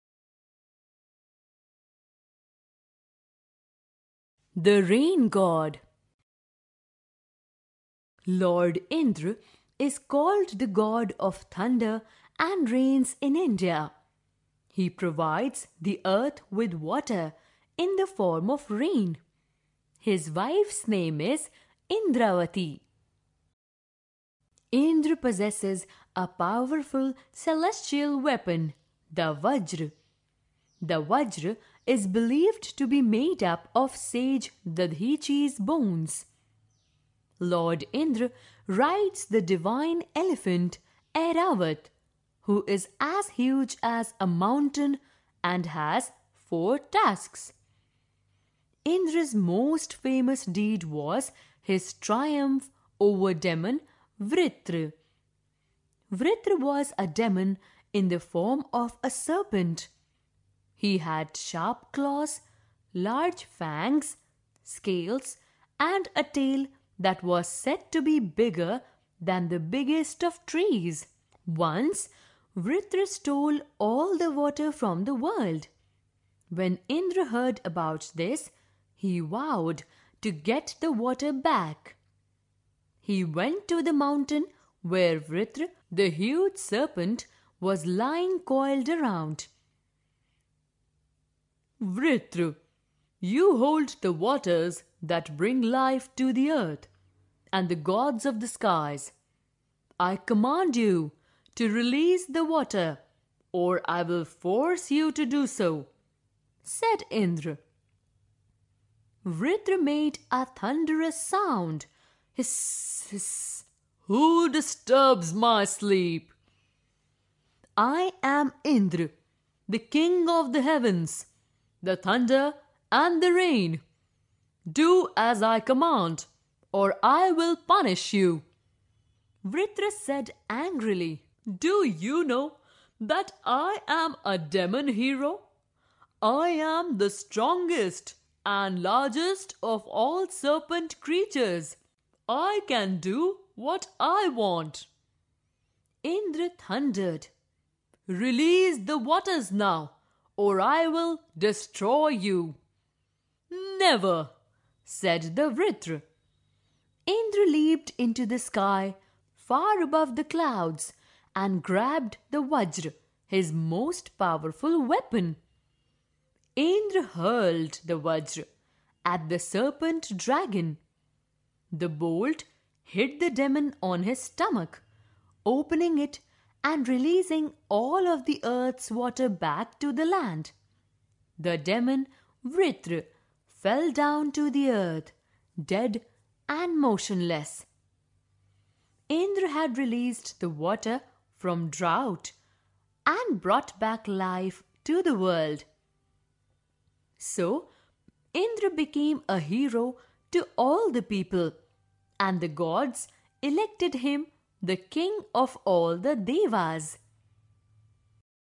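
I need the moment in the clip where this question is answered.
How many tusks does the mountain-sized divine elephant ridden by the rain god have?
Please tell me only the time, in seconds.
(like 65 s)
46 s.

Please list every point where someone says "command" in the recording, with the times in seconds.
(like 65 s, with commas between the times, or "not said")
100 s, 125 s.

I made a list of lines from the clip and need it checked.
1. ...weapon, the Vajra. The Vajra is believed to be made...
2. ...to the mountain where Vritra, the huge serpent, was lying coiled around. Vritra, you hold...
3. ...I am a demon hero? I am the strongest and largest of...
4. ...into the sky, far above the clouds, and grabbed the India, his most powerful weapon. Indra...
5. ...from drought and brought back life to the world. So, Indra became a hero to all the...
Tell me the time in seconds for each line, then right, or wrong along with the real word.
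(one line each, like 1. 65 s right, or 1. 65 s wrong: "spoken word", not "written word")
1. 28 s right
2. 83 s right
3. 133 s right
4. 157 s wrong: "Vajra", not "India"
5. 191 s right.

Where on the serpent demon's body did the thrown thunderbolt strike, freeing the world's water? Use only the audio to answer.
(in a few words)
His stomach.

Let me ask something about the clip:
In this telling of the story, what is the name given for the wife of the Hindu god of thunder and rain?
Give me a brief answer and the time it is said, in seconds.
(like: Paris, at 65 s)
Indravati, at 21 s.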